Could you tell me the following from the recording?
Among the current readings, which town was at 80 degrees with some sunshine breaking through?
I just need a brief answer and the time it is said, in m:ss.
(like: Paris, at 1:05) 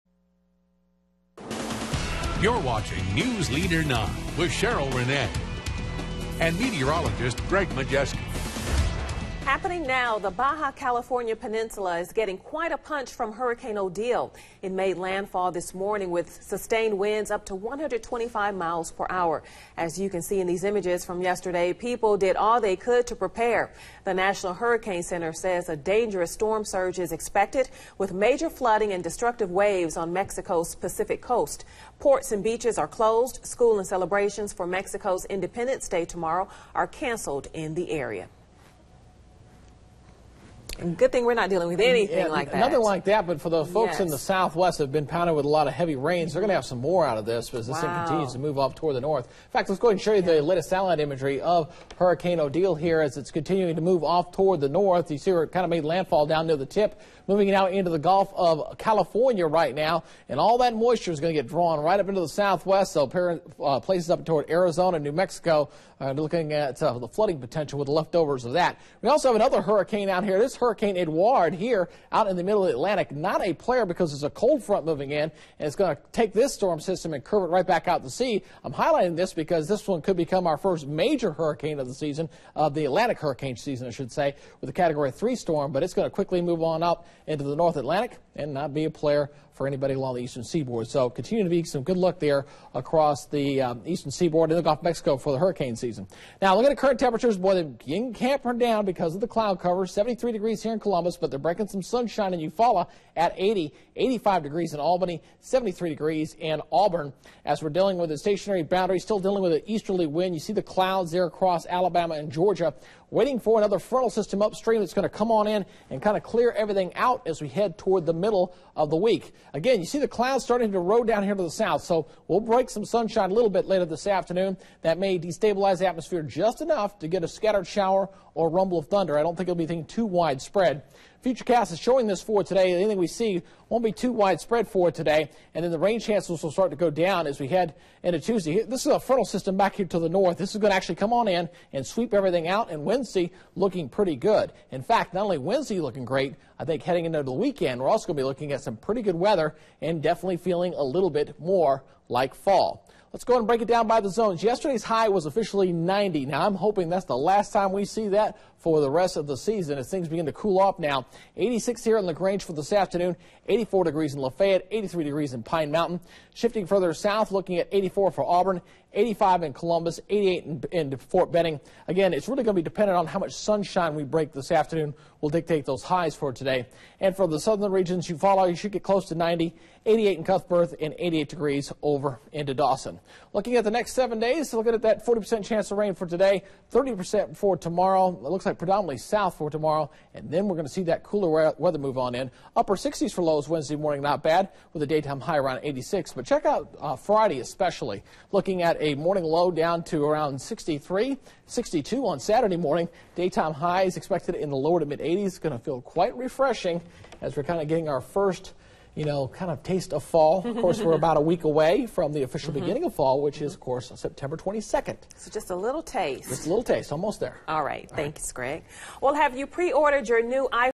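Eufaula, at 1:42.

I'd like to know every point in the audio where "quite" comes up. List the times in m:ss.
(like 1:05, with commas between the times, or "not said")
0:12, 3:25.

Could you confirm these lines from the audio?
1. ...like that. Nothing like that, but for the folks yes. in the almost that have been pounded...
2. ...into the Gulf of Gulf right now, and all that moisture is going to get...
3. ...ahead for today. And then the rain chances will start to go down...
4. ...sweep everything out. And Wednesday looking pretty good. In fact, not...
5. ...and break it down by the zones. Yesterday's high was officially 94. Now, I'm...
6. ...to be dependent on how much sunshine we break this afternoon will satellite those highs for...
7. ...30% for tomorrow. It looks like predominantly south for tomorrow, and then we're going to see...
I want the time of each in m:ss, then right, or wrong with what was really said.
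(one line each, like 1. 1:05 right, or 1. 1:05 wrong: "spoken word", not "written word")
1. 0:42 wrong: "southwest", not "almost"
2. 0:57 wrong: "California", not "Gulf"
3. 2:14 wrong: "widespread", not "ahead"
4. 2:21 right
5. 2:33 wrong: "90", not "94"
6. 2:52 wrong: "dictate", not "satellite"
7. 3:06 right.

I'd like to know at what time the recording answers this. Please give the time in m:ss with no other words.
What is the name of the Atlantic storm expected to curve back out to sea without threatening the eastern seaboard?
1:10.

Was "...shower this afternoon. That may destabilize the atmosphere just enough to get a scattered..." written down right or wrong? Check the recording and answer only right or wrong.
wrong.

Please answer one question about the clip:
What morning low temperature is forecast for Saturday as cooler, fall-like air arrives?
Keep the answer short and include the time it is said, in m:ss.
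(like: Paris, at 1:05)
62, at 3:21.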